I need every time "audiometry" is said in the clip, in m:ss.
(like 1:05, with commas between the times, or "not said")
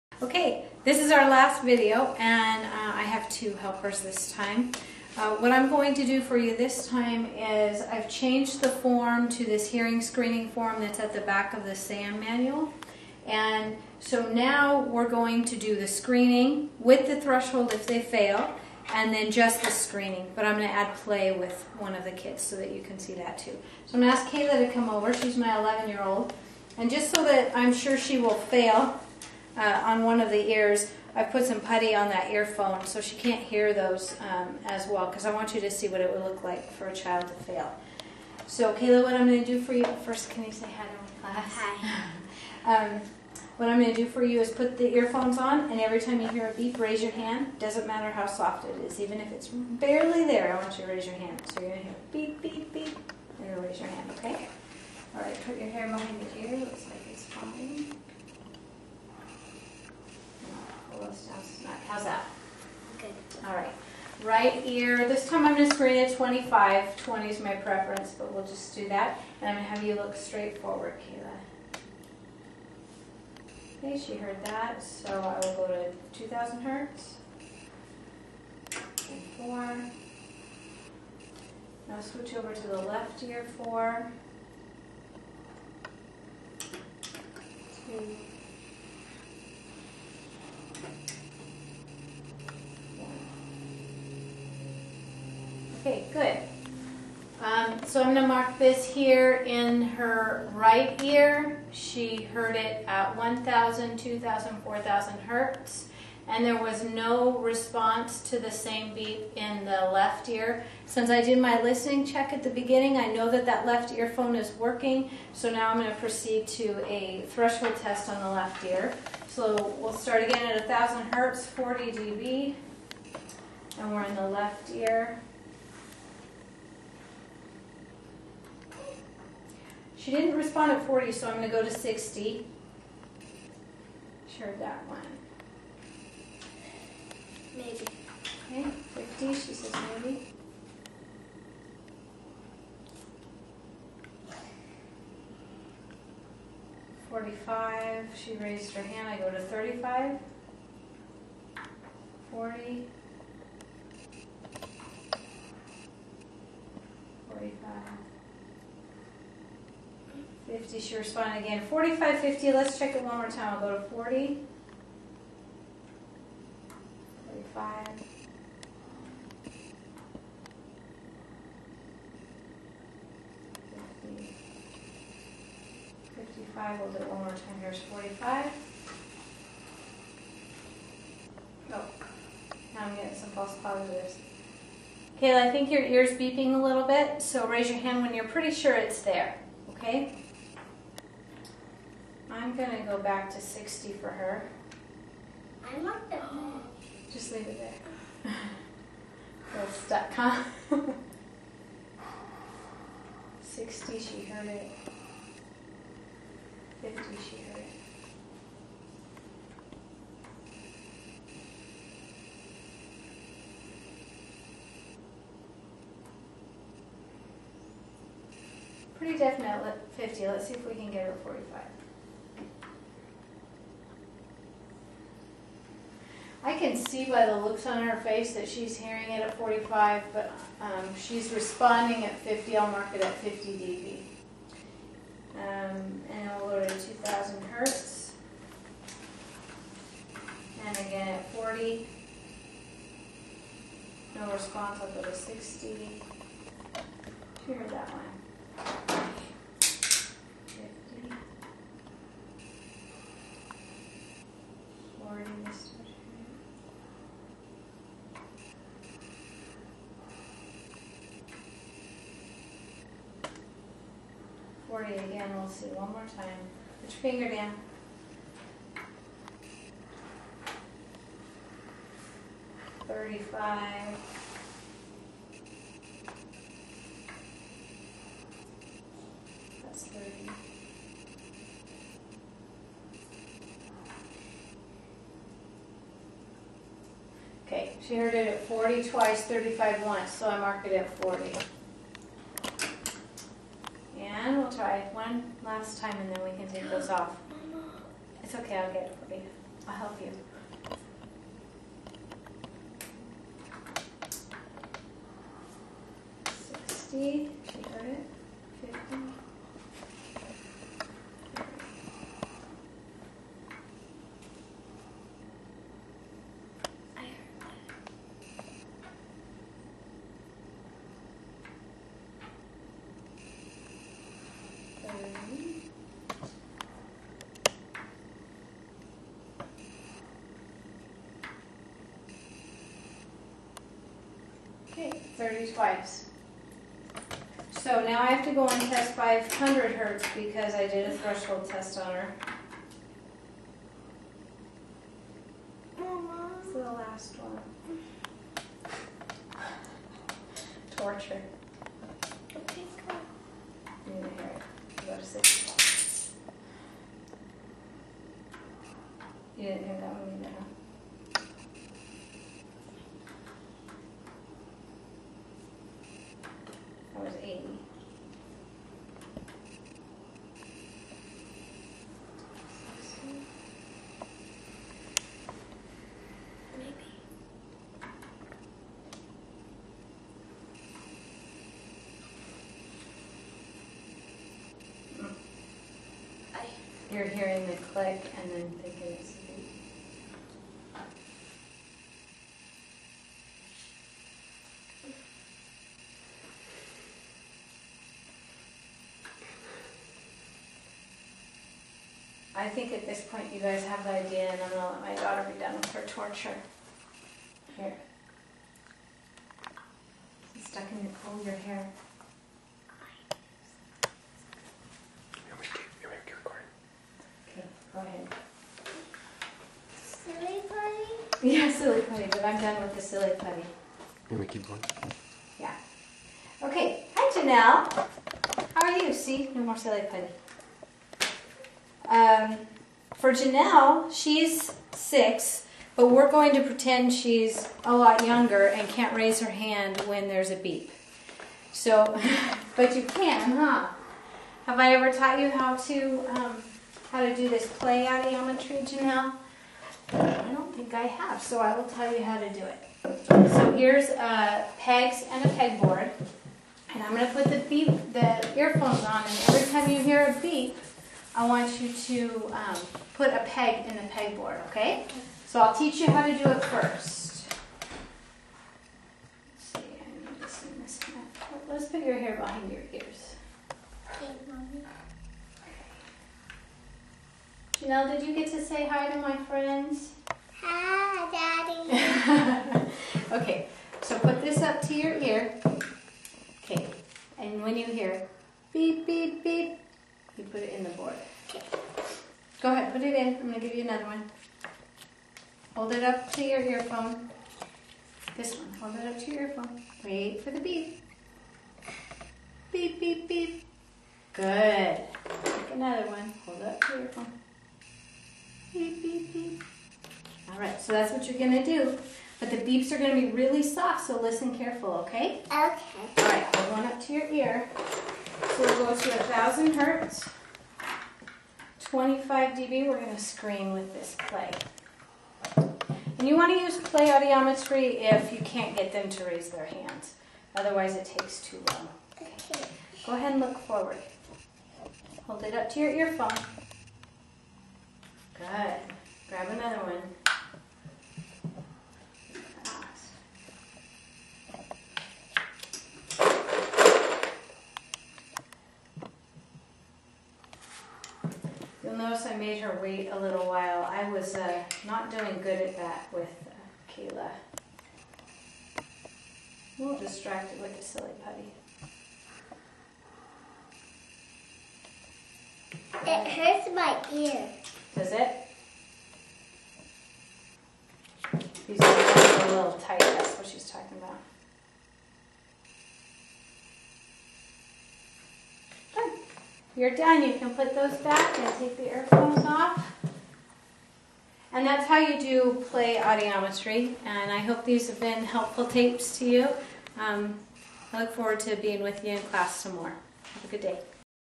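7:27, 8:46, 9:45.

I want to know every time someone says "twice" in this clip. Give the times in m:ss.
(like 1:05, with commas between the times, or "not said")
4:48, 5:35.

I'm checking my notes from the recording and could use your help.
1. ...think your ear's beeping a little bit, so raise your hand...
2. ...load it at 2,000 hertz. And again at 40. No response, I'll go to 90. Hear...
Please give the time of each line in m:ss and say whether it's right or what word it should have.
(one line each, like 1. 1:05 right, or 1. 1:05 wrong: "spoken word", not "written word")
1. 3:05 right
2. 3:56 wrong: "60", not "90".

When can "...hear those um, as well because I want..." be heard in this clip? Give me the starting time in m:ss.
0:33.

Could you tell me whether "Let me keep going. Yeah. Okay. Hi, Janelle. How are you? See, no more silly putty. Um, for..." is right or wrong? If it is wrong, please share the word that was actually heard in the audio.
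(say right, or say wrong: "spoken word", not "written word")
right.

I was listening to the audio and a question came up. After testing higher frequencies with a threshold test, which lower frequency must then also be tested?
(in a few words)
500 hertz.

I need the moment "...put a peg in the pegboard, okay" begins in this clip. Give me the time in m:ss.
7:42.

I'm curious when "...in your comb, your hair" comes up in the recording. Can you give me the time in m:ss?
6:50.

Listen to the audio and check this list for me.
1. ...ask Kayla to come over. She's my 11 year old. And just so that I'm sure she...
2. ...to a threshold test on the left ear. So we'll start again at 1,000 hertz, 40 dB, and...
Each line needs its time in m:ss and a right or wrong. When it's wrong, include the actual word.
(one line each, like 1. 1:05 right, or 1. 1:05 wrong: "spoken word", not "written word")
1. 0:24 right
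2. 1:56 right.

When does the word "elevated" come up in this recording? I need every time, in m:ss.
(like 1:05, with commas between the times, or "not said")
not said.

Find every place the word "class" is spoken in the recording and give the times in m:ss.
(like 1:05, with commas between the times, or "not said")
0:41, 9:52.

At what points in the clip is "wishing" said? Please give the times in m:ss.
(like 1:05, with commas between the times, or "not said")
not said.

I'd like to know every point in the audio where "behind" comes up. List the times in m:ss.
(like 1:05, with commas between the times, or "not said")
0:55, 7:52.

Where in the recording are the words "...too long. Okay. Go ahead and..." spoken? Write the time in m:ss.
8:51.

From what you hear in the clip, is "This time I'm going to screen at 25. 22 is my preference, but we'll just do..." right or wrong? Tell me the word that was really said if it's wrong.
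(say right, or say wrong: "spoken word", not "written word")
wrong: "20", not "22".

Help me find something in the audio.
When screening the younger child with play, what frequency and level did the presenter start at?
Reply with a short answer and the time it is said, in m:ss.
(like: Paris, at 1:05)
1,000 hertz, 25 dB, at 8:38.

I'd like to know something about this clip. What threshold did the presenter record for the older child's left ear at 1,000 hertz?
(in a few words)
50 dB.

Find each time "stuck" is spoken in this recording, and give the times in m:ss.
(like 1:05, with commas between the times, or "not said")
3:19, 6:50.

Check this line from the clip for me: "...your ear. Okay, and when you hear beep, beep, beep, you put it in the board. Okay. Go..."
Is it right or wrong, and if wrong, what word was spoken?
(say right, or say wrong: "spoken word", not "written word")
right.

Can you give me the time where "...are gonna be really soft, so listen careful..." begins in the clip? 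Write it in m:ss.
8:32.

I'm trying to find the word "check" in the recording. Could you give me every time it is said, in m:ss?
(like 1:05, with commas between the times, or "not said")
1:52, 2:42.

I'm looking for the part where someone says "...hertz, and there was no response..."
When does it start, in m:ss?
1:45.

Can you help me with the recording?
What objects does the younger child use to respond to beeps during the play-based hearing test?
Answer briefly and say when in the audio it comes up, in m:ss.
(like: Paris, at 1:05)
pegs and a pegboard, at 7:34.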